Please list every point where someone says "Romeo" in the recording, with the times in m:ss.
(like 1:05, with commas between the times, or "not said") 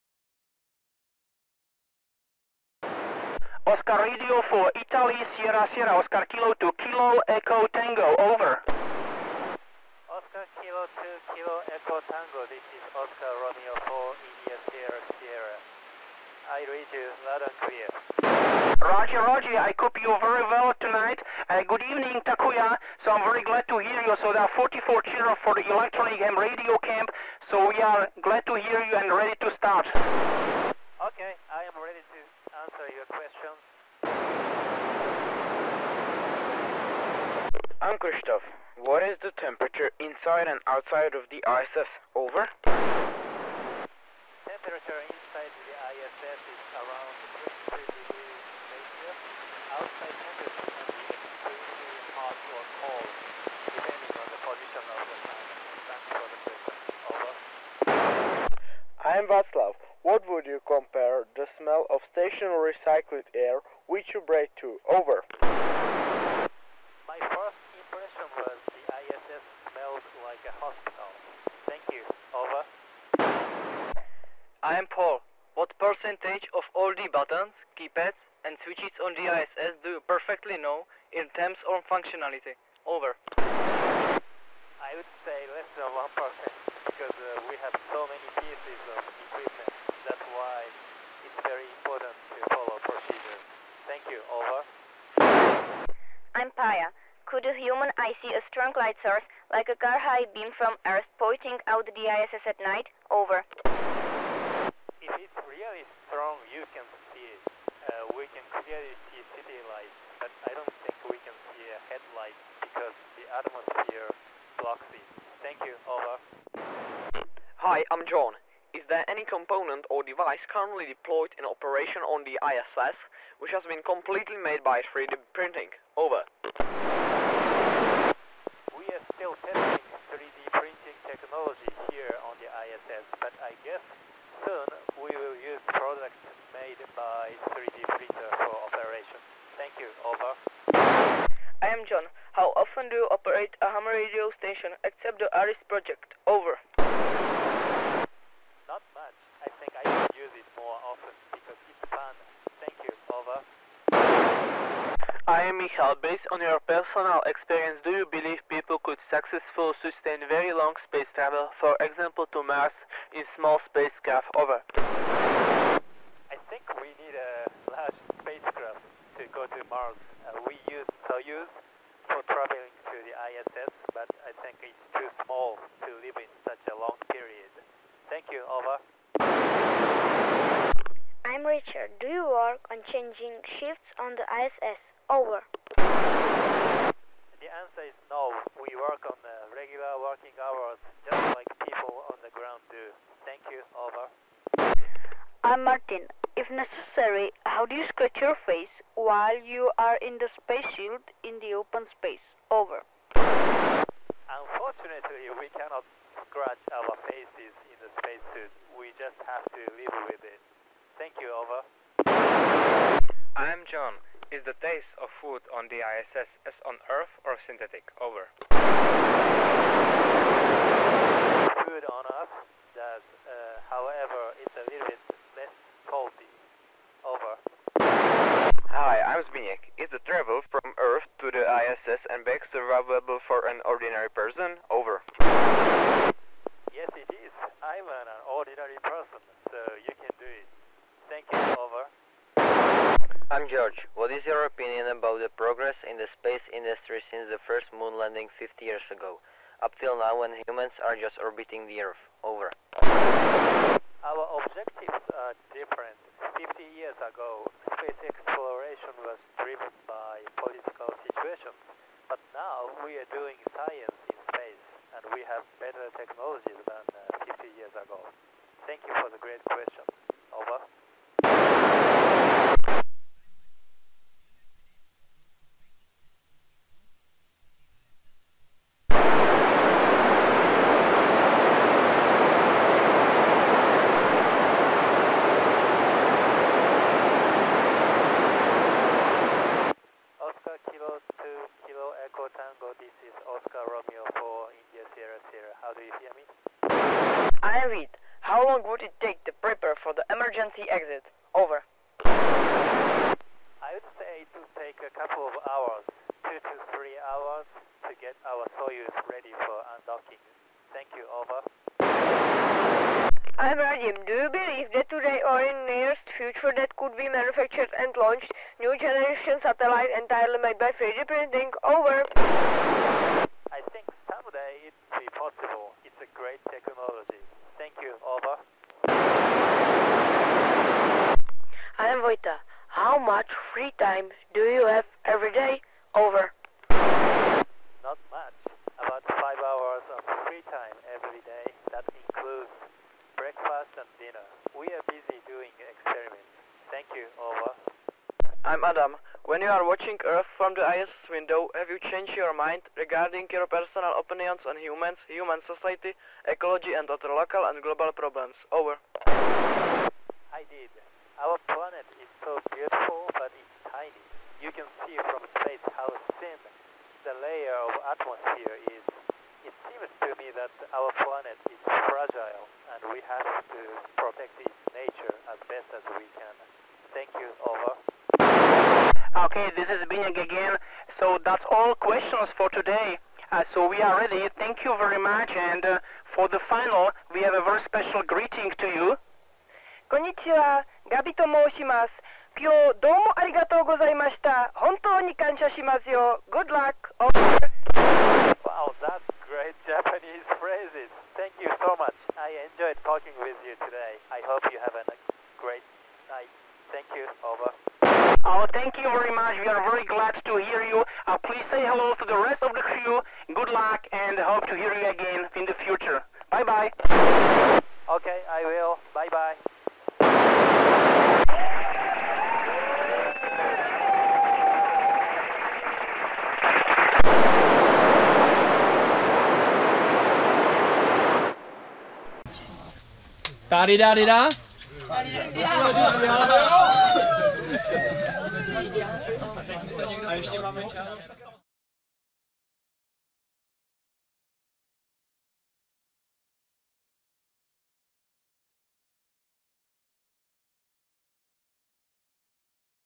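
0:13, 4:53.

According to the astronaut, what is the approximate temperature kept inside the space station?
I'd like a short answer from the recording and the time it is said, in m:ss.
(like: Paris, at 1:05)
23 degrees Celsius, at 0:47.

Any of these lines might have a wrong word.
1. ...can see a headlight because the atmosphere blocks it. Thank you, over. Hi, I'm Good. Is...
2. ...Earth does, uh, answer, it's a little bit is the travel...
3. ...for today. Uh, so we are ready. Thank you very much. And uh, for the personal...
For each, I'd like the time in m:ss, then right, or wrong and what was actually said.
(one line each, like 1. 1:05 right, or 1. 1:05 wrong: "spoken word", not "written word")
1. 1:51 wrong: "John", not "Good"
2. 3:42 wrong: "however", not "answer"
3. 6:22 wrong: "final", not "personal".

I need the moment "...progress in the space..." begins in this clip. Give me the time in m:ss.
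4:05.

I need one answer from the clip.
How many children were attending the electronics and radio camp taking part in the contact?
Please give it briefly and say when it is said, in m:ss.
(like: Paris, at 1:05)
44, at 0:24.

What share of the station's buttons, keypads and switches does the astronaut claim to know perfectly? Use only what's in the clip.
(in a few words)
less than 1%.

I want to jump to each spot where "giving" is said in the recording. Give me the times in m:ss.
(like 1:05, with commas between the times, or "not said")
not said.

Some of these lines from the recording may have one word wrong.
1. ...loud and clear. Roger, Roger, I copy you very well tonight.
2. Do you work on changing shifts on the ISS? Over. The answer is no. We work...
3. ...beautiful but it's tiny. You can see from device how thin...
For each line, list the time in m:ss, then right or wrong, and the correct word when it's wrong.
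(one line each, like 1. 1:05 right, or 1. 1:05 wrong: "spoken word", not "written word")
1. 0:17 right
2. 3:02 right
3. 6:02 wrong: "space", not "device".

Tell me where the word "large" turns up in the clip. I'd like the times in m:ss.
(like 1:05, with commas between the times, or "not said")
2:47.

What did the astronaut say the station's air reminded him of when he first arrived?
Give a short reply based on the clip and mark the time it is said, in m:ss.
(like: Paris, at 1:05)
a hospital, at 1:10.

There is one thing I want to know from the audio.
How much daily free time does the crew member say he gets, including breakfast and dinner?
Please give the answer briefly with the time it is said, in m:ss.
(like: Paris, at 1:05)
about 5 hours, at 5:38.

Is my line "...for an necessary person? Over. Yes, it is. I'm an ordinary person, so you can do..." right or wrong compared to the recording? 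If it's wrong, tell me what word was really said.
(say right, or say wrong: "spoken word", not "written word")
wrong: "ordinary", not "necessary".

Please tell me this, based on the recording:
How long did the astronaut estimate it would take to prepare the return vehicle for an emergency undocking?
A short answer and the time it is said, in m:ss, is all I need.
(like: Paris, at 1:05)
2 to 3 hours, at 5:06.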